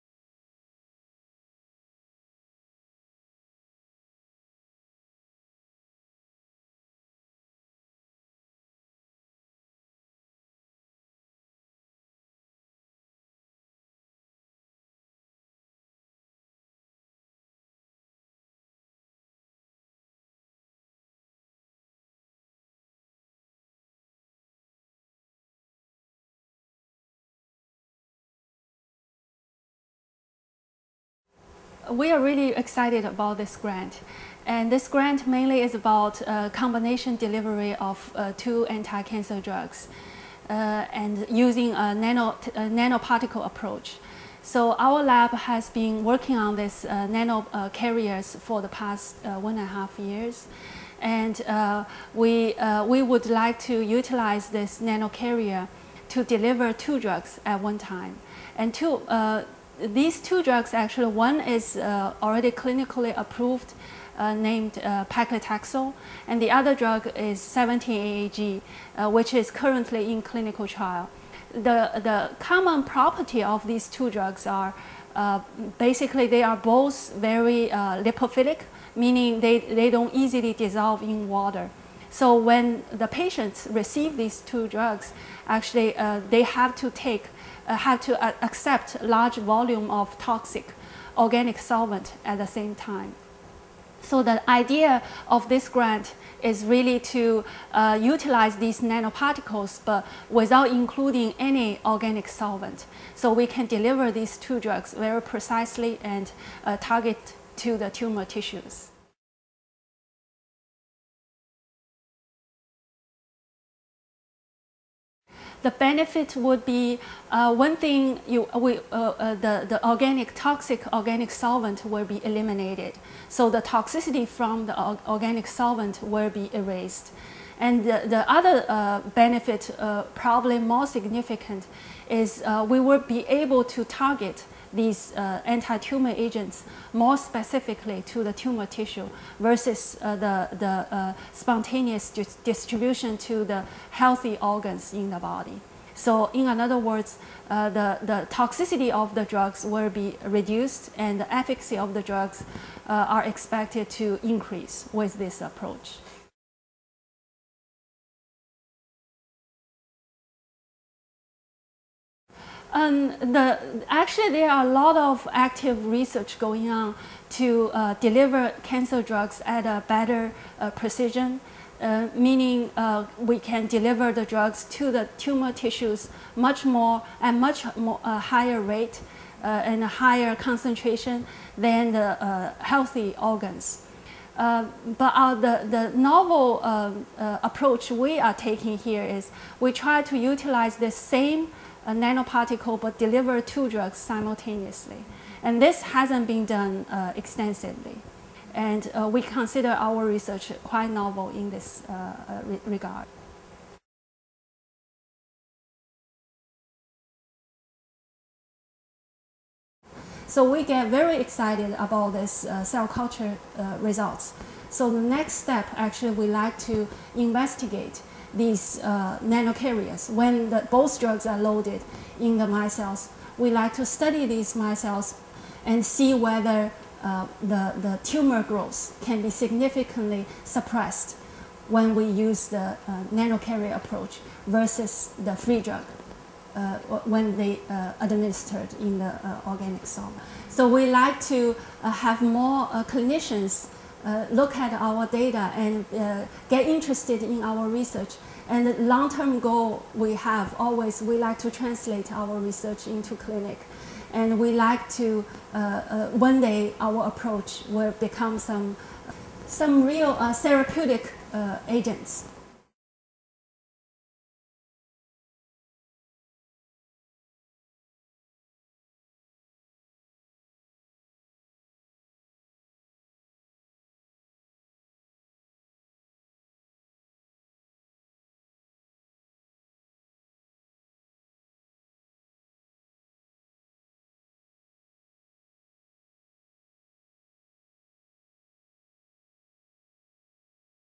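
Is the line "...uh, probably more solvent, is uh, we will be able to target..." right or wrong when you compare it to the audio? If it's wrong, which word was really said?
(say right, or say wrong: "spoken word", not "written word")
wrong: "significant", not "solvent".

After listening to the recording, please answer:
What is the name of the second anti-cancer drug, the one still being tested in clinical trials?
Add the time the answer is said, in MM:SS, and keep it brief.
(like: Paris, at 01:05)
17-AAG, at 01:07.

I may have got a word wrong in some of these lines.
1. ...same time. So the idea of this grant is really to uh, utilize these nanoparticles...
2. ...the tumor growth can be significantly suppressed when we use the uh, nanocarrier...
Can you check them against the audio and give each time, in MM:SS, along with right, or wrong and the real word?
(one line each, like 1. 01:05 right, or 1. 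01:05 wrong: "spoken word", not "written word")
1. 01:32 right
2. 03:47 right.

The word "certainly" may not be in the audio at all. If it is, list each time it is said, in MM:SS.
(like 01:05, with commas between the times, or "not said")
not said.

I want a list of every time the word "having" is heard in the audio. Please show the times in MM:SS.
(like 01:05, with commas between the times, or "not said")
not said.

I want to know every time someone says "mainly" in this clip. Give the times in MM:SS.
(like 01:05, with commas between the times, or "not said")
00:35.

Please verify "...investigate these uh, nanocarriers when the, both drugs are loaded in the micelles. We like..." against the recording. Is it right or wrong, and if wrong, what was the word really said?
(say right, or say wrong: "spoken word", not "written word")
right.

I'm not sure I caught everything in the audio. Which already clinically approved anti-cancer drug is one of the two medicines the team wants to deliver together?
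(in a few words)
paclitaxel.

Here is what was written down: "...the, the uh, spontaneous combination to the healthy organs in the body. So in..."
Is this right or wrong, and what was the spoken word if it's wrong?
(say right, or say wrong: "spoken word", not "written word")
wrong: "distribution", not "combination".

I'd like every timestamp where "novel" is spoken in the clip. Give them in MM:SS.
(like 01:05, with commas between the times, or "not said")
03:05, 03:20.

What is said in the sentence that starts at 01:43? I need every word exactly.
So we can deliver these two drugs very precisely and uh, target to the tumor tissues.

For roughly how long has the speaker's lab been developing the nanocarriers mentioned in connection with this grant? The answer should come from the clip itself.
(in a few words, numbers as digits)
1.5 years.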